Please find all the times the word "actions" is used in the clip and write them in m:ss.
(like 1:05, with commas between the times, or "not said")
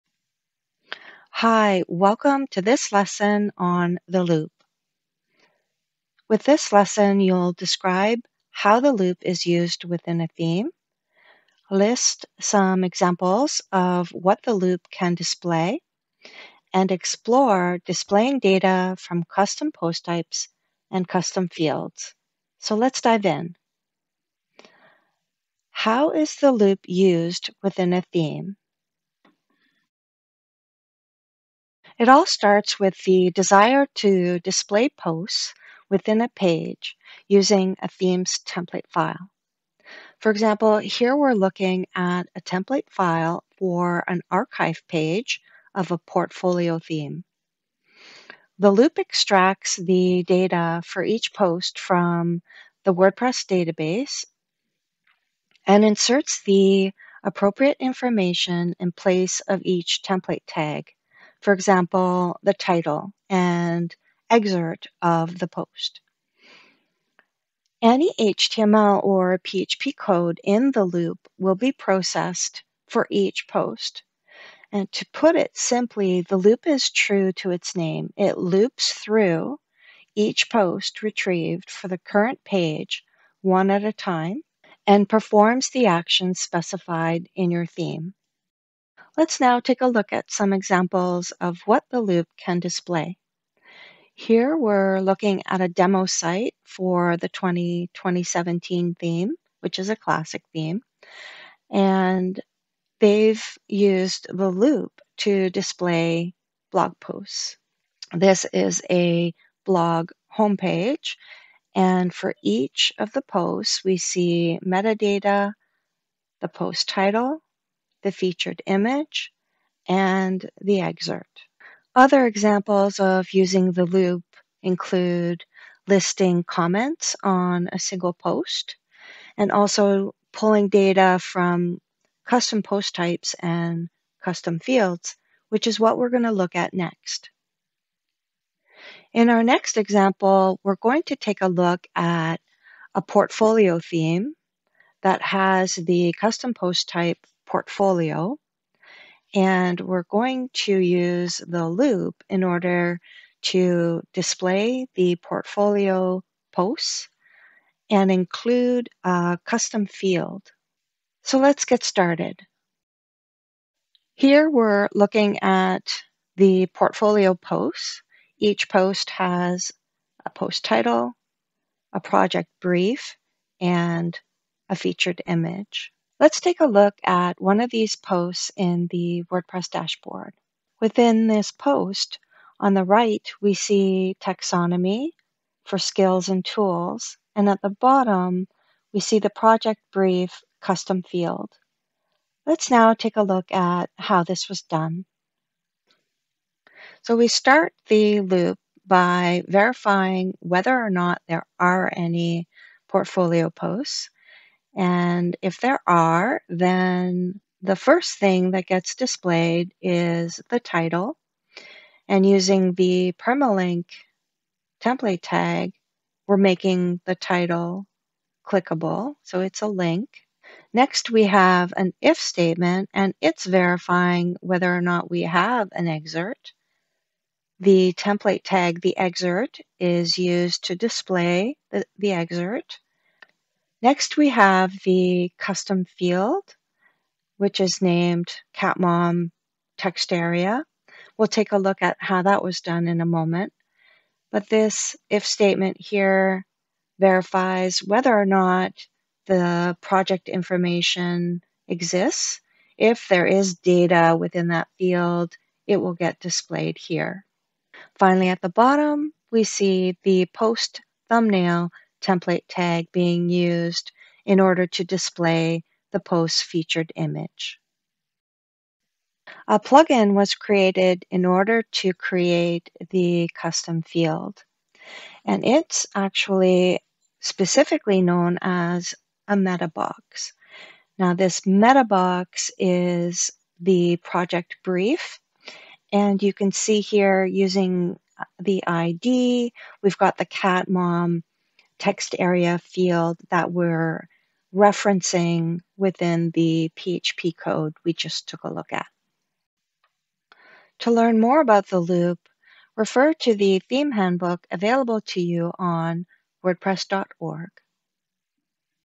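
1:25.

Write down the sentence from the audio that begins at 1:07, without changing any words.
Any HTML or PHP code in the loop will be processed for each post.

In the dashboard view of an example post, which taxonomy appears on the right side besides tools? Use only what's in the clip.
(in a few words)
skills.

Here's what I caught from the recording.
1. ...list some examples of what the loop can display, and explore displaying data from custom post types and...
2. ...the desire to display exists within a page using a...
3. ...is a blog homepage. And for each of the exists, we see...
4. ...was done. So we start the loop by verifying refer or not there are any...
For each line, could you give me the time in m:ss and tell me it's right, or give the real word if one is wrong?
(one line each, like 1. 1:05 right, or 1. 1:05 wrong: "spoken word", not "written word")
1. 0:11 right
2. 0:33 wrong: "posts", not "exists"
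3. 1:48 wrong: "posts", not "exists"
4. 3:14 wrong: "whether", not "refer".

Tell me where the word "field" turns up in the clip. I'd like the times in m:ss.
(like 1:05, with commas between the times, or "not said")
0:21, 2:14, 2:39, 3:11, 3:55, 4:14, 4:33, 4:52.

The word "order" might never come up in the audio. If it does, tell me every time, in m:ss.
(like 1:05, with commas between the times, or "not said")
2:32, 4:24, 4:31.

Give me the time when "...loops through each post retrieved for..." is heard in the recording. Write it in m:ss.
1:18.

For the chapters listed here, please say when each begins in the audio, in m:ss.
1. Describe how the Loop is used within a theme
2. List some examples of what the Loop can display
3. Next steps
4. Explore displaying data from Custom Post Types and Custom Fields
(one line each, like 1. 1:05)
1. 0:23
2. 1:29
3. 4:59
4. 2:19.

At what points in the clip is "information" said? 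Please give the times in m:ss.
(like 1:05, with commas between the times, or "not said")
0:57, 4:10.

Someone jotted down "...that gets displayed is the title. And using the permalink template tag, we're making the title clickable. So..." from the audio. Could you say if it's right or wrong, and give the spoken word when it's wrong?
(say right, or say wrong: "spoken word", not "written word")
right.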